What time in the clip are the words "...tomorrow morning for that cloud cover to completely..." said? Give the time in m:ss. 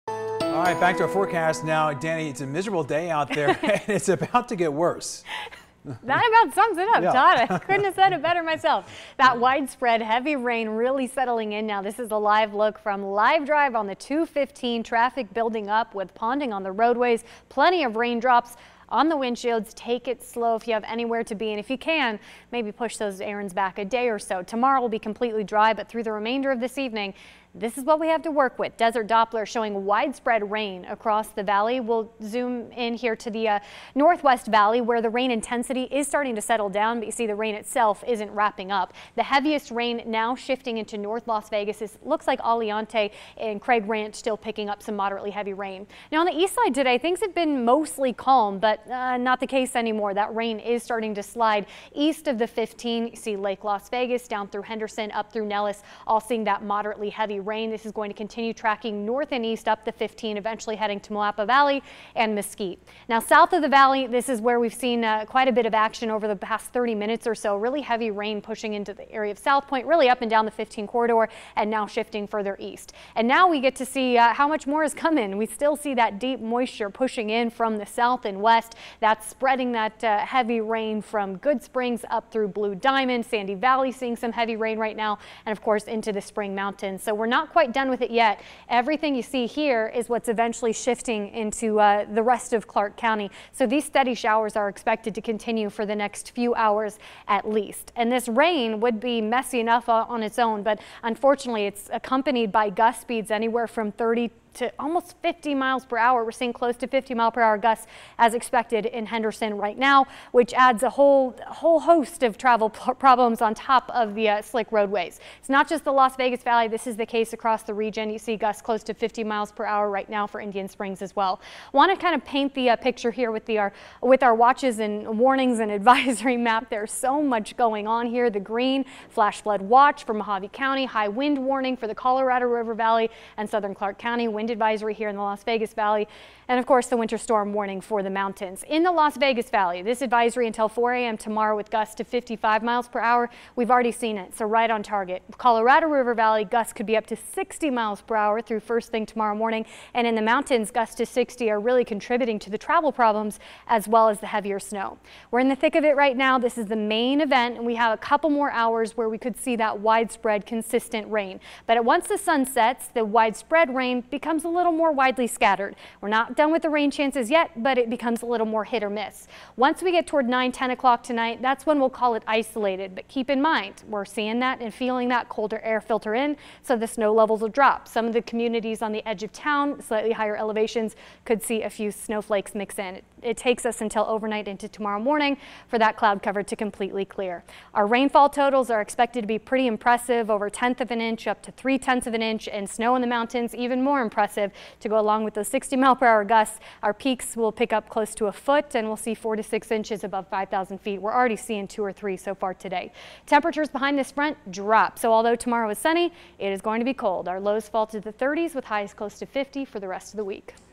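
3:04.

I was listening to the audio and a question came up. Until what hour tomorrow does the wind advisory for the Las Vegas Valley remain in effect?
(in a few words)
4 a.m.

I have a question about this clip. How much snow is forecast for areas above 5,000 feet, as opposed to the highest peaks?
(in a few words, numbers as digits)
4 to 6 inches.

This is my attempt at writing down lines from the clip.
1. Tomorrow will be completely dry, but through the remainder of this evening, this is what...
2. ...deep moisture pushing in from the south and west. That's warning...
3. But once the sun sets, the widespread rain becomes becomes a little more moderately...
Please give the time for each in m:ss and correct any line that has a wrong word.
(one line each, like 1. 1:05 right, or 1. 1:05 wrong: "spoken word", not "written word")
1. 0:24 right
2. 1:16 wrong: "spreading", not "warning"
3. 2:41 wrong: "widely", not "moderately".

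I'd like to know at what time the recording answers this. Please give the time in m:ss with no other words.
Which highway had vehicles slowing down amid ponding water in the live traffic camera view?
0:13.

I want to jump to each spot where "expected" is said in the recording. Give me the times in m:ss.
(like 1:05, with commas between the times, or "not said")
1:34, 1:48, 3:08.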